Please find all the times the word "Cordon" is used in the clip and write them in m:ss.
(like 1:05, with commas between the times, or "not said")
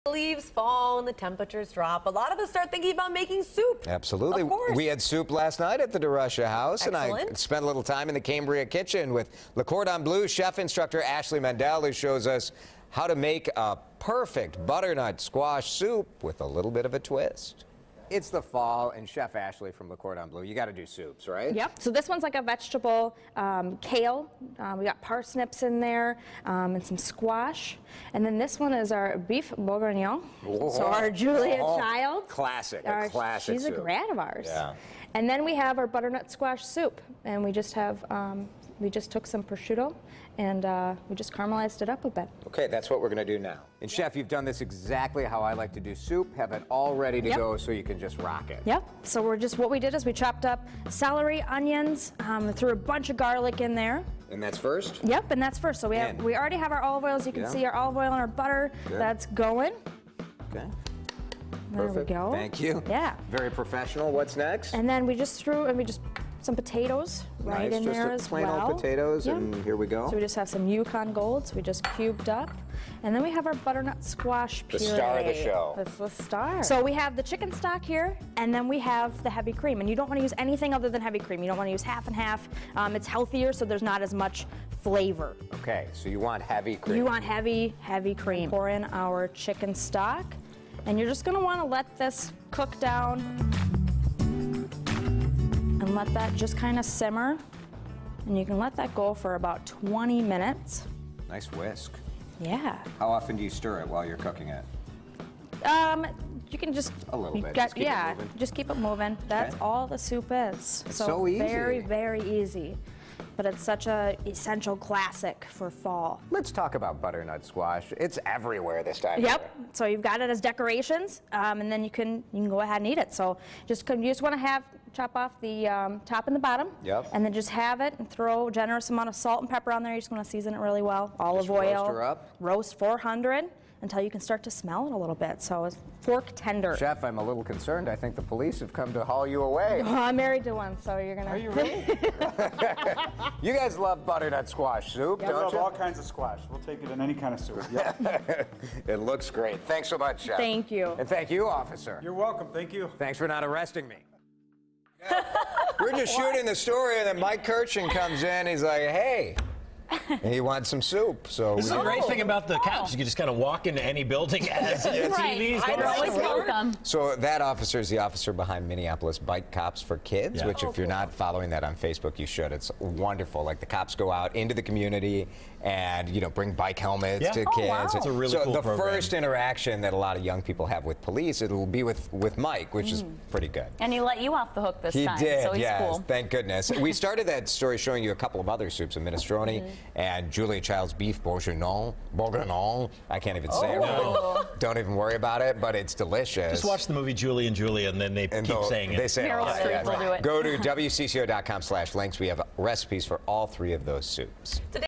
0:09, 0:19.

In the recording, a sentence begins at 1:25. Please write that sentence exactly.
Okay, so you want heavy cream.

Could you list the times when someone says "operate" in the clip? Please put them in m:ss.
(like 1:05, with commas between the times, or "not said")
not said.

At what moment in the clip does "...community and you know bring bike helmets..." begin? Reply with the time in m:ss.
2:54.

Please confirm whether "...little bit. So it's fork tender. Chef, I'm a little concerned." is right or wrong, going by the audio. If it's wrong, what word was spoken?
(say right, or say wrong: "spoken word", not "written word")
right.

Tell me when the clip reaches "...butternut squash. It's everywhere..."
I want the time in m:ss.
1:57.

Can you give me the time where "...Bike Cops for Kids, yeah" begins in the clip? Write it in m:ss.
2:49.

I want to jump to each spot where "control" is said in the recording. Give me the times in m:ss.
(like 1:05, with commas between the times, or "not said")
not said.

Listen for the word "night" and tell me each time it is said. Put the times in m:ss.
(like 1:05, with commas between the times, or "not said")
0:05.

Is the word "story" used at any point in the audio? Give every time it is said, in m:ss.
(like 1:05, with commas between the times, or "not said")
2:36, 3:07.